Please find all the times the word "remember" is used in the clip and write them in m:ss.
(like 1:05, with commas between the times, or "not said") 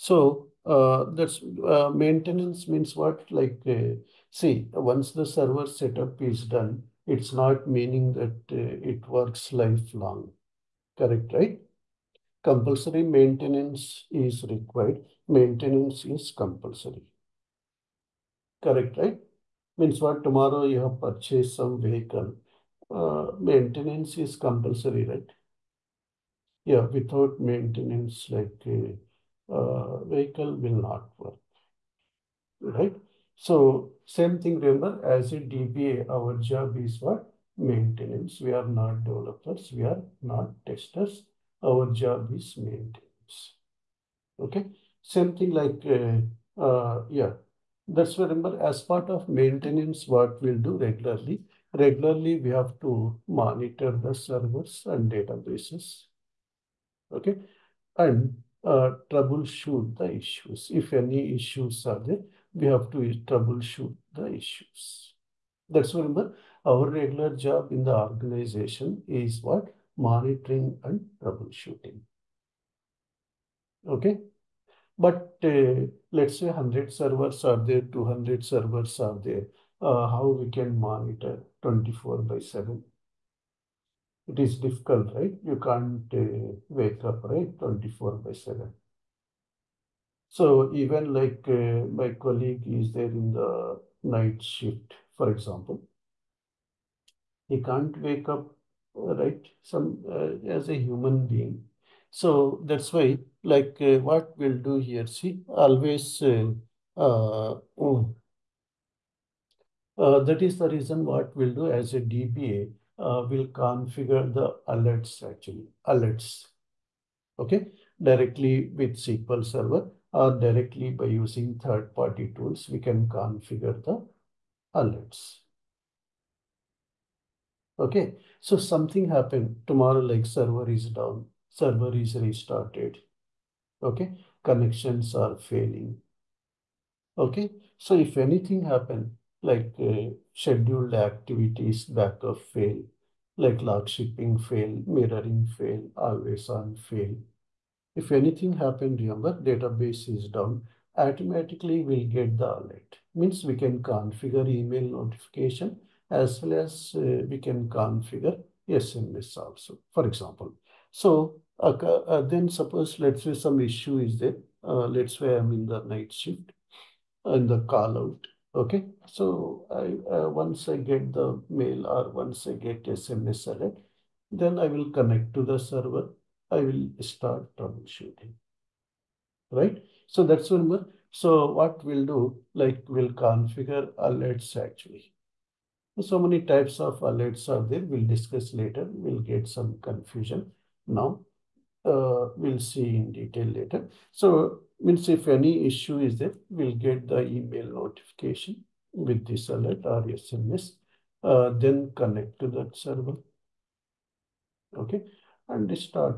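0:34, 0:48, 2:28.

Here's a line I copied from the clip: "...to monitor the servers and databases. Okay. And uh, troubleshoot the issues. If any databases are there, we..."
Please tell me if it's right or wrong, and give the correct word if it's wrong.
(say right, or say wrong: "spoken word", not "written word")
wrong: "issues", not "databases".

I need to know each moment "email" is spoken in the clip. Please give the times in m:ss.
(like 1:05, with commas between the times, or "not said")
2:34, 3:17.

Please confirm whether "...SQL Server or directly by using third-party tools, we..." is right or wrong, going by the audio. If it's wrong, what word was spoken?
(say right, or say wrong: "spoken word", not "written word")
right.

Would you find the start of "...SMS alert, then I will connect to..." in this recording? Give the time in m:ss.
2:52.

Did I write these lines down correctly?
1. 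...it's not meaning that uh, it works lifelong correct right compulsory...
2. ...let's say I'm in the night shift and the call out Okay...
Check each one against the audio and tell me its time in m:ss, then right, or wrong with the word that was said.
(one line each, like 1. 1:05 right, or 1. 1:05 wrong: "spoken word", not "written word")
1. 0:07 right
2. 2:44 right.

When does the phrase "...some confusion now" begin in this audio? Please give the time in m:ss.
3:09.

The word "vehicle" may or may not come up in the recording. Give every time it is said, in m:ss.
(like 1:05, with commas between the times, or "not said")
0:21, 0:30.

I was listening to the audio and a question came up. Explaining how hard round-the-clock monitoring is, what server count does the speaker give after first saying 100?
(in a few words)
200.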